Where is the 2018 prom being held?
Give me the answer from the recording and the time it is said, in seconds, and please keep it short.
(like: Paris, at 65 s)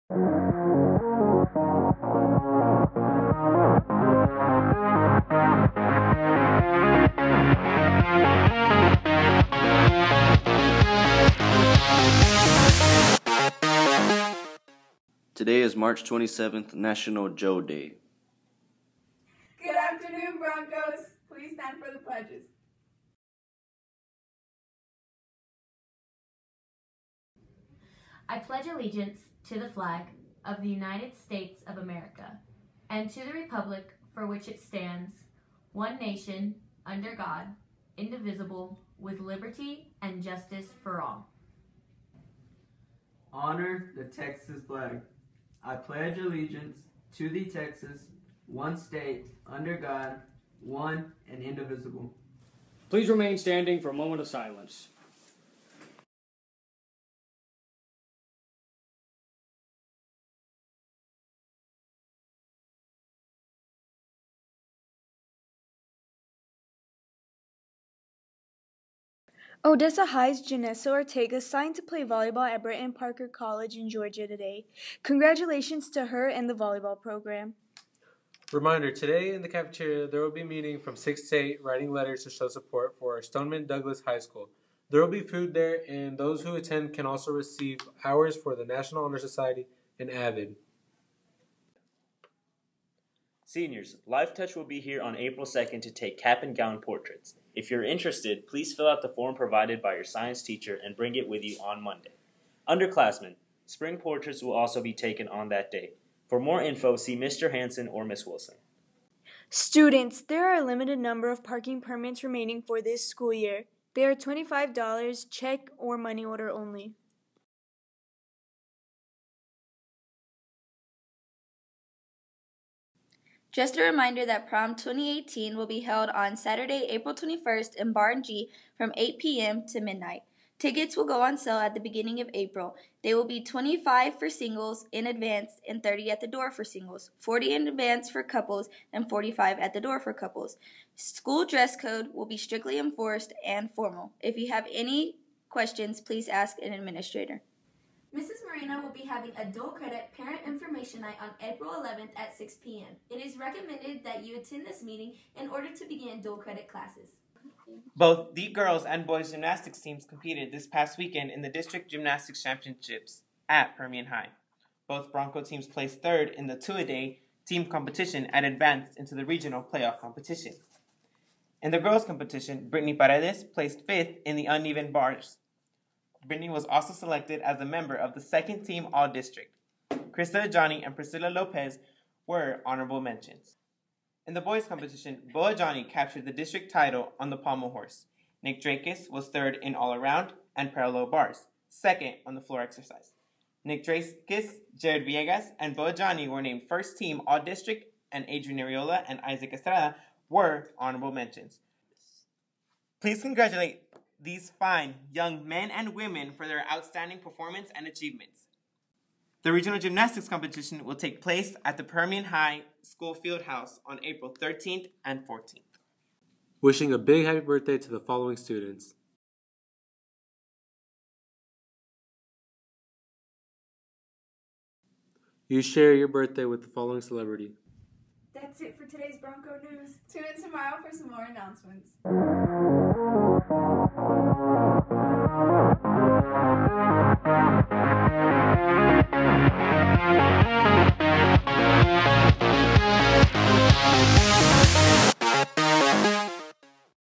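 Barn G, at 127 s.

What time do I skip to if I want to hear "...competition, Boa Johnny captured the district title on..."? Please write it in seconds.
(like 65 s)
184 s.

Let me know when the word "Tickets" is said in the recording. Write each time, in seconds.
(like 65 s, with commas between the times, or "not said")
130 s.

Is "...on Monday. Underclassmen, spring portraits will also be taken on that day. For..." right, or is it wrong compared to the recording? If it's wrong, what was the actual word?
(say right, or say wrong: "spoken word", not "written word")
right.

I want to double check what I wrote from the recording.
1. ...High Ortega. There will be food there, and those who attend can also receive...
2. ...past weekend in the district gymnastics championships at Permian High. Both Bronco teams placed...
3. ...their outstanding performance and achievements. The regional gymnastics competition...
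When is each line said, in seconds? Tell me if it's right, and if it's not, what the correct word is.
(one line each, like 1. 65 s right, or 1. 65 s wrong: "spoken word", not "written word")
1. 84 s wrong: "School", not "Ortega"
2. 160 s right
3. 206 s right.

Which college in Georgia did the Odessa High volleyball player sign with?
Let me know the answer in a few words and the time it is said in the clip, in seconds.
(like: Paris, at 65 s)
Brewton-Parker College, at 72 s.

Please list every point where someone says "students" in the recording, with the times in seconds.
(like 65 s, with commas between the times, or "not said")
109 s, 218 s.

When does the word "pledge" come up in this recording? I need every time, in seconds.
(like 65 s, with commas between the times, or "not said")
21 s, 28 s, 45 s.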